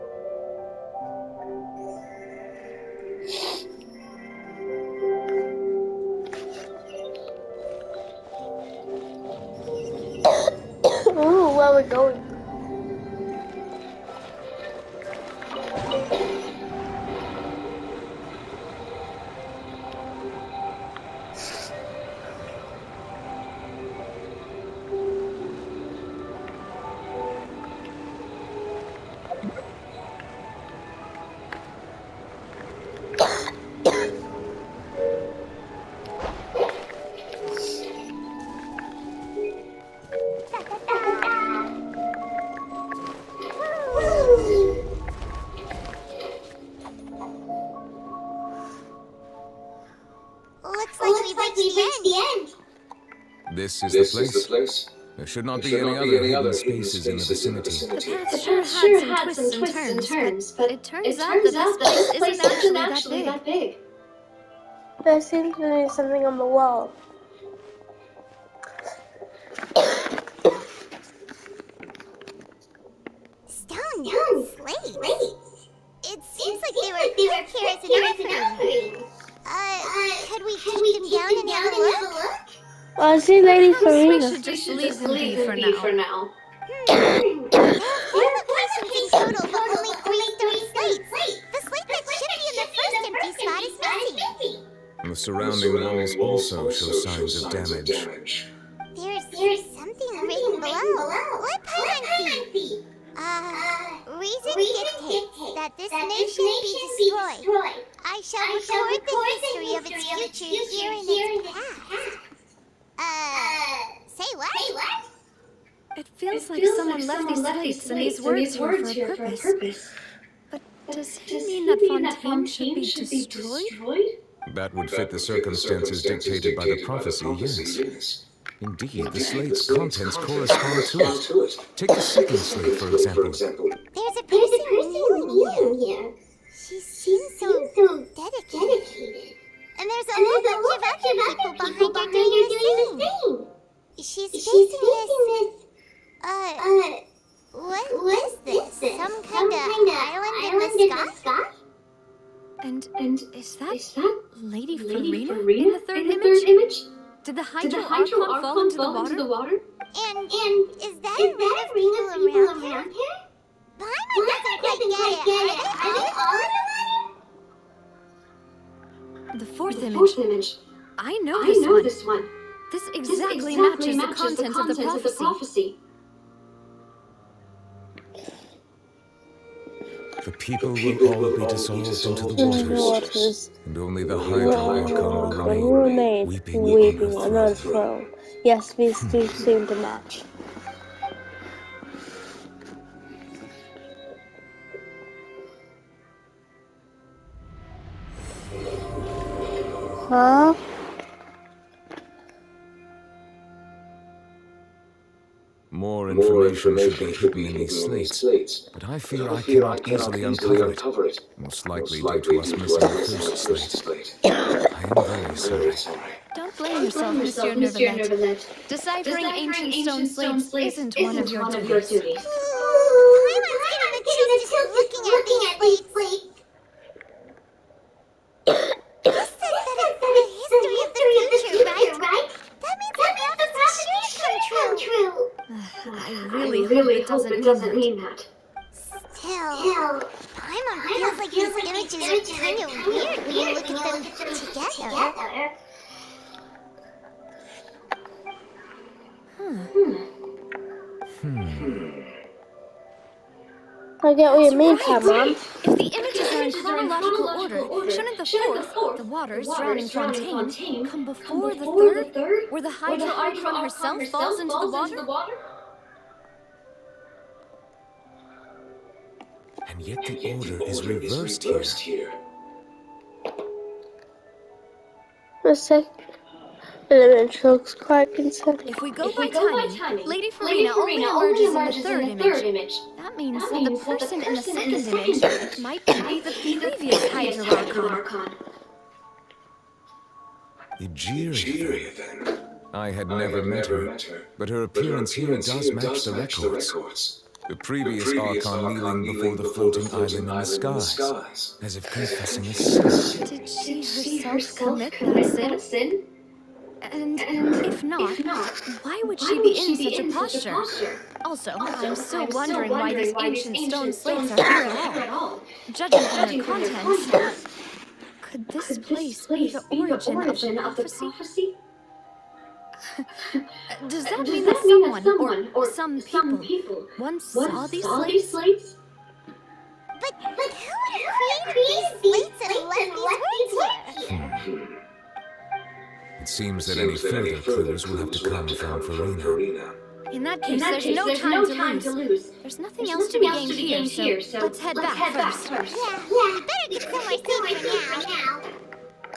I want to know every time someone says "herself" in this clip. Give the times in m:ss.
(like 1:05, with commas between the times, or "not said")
4:23, 5:04.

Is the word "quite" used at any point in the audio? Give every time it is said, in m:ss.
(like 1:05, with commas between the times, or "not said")
2:44, 4:37.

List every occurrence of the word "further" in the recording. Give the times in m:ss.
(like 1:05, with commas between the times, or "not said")
5:37.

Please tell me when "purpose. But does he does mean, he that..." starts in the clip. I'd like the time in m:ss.
1:59.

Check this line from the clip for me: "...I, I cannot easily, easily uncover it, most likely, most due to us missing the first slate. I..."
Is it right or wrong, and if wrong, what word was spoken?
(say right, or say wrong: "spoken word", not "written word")
right.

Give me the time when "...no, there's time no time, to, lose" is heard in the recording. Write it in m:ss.
5:40.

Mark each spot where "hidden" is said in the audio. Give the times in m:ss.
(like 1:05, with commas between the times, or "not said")
3:27.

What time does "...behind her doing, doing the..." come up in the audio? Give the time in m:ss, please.
2:21.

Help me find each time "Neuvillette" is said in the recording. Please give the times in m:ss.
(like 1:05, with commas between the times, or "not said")
3:37.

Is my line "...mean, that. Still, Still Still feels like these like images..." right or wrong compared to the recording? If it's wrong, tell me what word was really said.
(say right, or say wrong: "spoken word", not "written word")
wrong: "Paimon", not "Still".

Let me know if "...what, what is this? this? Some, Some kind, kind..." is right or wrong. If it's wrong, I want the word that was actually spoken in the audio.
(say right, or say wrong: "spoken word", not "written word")
right.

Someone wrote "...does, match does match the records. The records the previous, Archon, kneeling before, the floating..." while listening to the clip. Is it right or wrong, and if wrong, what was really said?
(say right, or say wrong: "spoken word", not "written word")
right.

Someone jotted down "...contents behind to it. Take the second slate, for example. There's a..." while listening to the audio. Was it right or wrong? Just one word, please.
wrong.